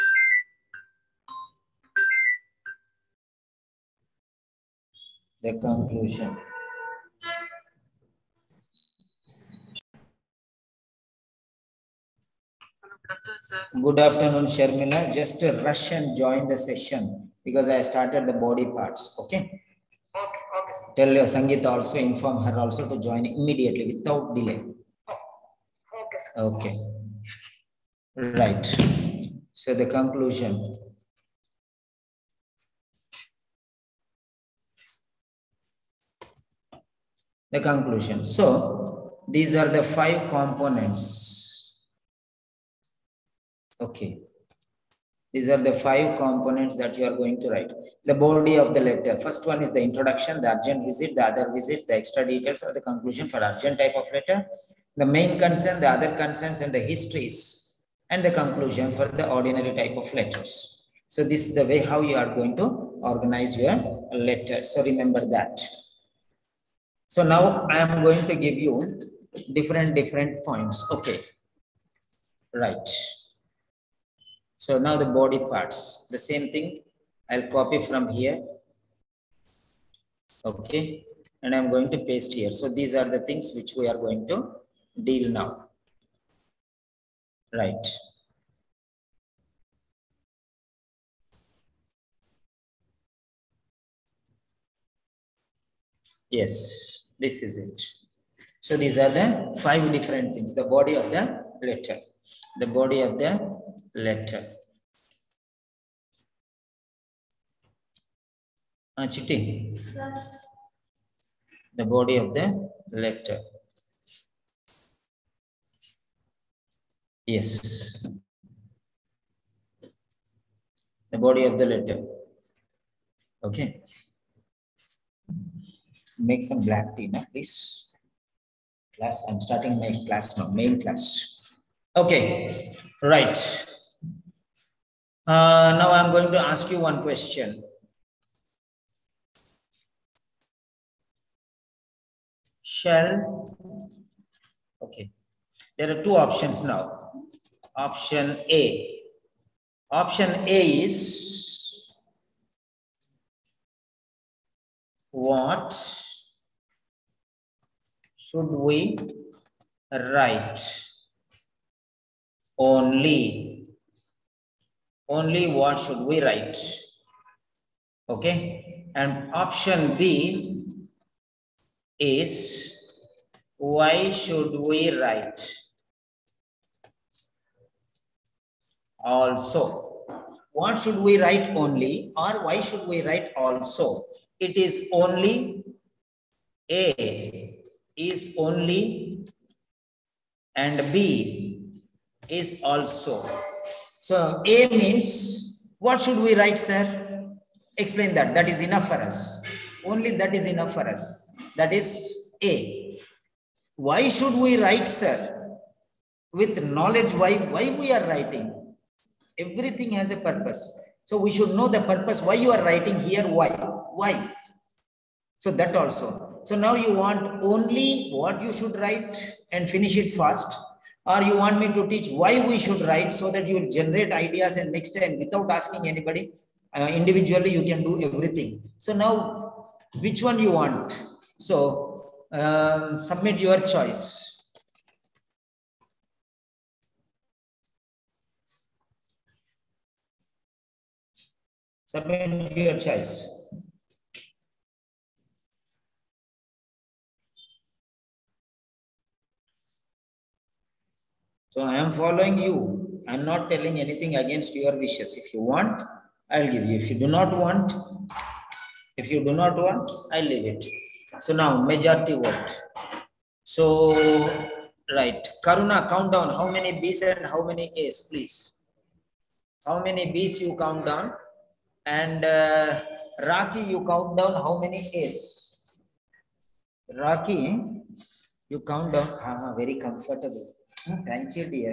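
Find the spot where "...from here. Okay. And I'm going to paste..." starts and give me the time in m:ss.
1:17.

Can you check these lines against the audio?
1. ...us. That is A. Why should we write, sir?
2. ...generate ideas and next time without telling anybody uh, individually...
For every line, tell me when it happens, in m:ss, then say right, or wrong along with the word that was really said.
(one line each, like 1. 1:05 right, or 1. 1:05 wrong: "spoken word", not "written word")
1. 3:20 right
2. 3:43 wrong: "asking", not "telling".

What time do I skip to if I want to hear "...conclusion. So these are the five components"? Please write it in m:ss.
0:37.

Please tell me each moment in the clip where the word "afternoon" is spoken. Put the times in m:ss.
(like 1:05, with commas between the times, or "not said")
0:14.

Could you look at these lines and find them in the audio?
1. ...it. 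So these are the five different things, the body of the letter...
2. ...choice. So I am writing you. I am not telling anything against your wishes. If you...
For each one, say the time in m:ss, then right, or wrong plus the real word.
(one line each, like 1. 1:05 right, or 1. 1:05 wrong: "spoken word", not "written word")
1. 1:37 right
2. 4:02 wrong: "following", not "writing".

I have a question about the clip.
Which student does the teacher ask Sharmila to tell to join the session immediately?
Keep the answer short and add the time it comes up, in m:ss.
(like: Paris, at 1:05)
Sangeeta, at 0:21.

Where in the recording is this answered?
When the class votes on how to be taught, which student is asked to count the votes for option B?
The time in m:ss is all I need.
4:25.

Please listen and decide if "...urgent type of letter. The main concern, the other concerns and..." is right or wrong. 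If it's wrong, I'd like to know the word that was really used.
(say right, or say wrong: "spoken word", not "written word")
right.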